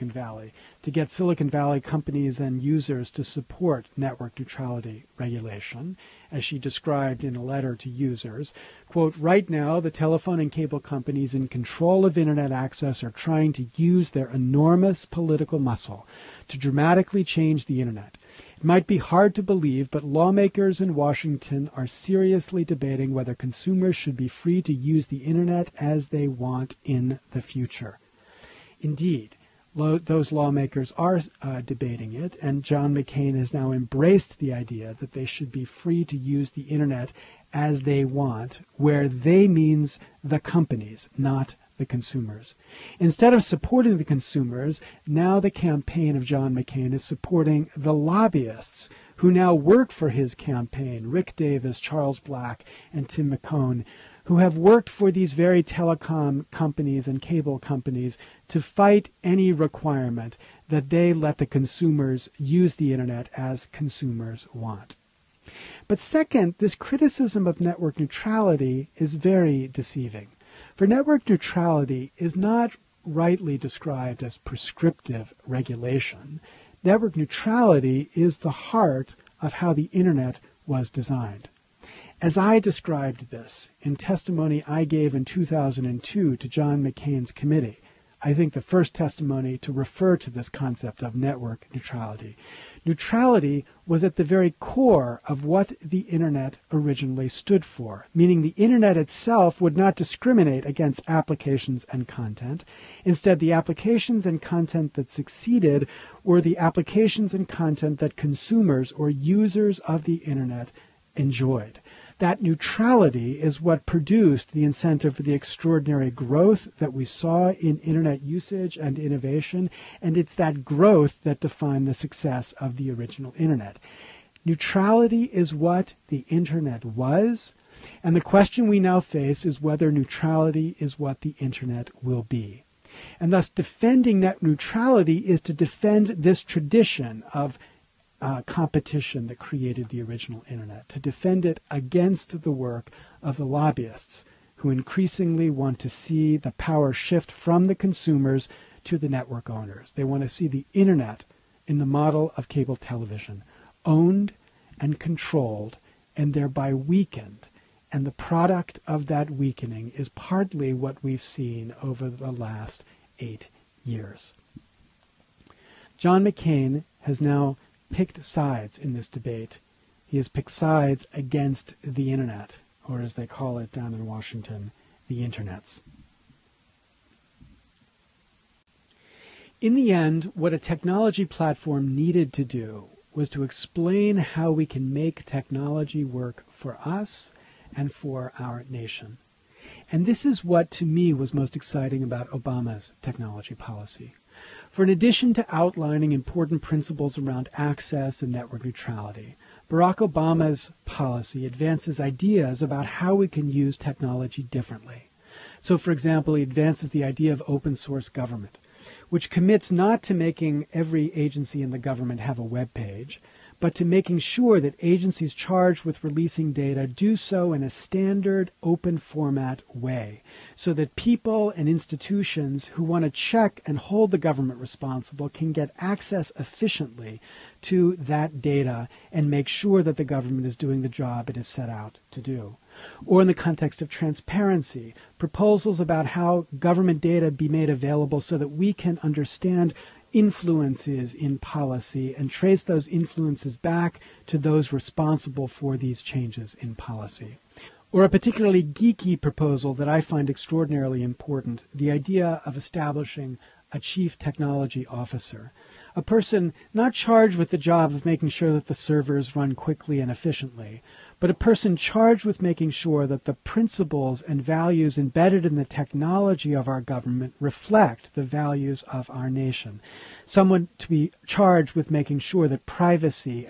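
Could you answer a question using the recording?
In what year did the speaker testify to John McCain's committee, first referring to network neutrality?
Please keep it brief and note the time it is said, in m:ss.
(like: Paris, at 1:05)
2002, at 1:25.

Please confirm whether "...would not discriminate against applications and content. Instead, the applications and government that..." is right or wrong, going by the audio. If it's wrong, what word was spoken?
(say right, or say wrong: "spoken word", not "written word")
wrong: "content", not "government".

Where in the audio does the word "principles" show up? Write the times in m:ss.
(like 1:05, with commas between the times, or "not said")
3:16, 4:23.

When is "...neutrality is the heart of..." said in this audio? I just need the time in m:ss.
1:17.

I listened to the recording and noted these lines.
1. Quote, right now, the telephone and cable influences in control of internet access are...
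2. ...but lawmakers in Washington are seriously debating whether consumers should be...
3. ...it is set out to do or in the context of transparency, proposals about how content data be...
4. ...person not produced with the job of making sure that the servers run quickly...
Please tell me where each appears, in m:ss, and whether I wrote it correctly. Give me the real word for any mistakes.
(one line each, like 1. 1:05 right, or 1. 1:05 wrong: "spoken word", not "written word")
1. 0:08 wrong: "companies", not "influences"
2. 0:19 right
3. 3:51 wrong: "government", not "content"
4. 4:16 wrong: "charged", not "produced".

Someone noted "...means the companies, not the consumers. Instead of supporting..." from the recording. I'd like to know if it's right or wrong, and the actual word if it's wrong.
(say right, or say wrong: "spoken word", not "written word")
right.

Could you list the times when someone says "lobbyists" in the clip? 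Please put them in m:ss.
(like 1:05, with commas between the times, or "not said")
0:47, 2:23.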